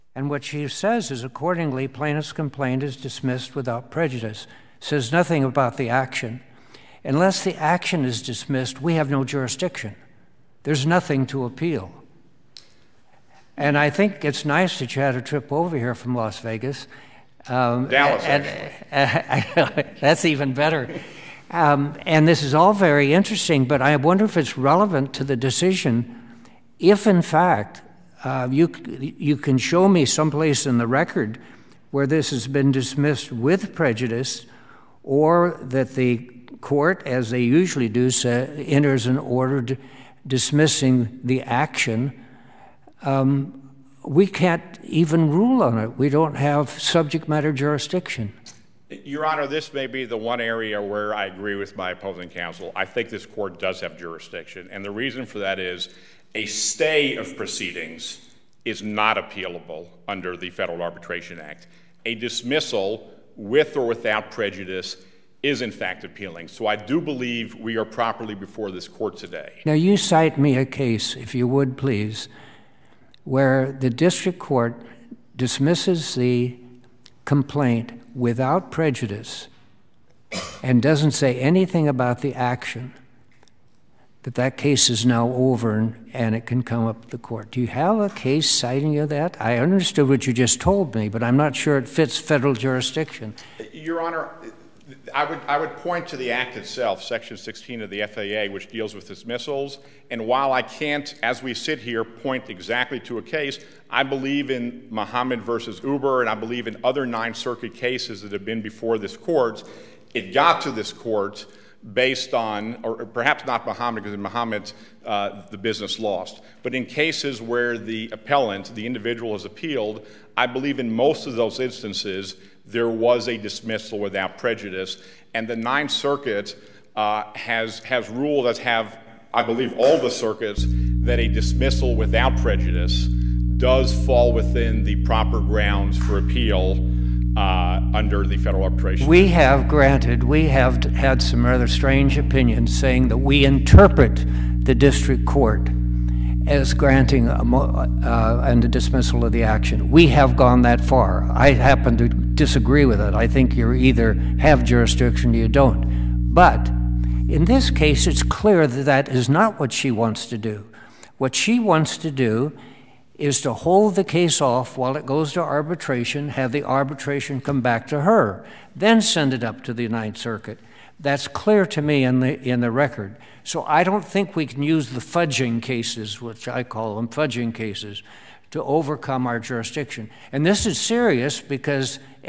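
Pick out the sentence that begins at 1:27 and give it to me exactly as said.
Do you have a case citing you that?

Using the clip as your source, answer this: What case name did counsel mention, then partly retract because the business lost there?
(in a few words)
Mohamed versus Uber.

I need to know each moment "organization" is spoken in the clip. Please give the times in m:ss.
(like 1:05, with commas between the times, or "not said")
not said.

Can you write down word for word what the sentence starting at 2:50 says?
That's clear to me in the, in the record.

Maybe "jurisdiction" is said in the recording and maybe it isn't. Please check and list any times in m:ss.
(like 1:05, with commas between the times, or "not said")
0:09, 0:47, 0:53, 1:32, 2:34, 2:59.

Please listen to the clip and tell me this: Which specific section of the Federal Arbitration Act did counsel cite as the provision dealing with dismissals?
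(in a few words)
Section 16.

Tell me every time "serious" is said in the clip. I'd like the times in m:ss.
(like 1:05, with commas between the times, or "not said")
3:00.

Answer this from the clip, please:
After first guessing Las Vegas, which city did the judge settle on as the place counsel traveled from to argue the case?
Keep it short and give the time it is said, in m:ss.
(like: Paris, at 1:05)
Dallas, at 0:17.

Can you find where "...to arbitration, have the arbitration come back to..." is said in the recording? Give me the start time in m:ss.
2:45.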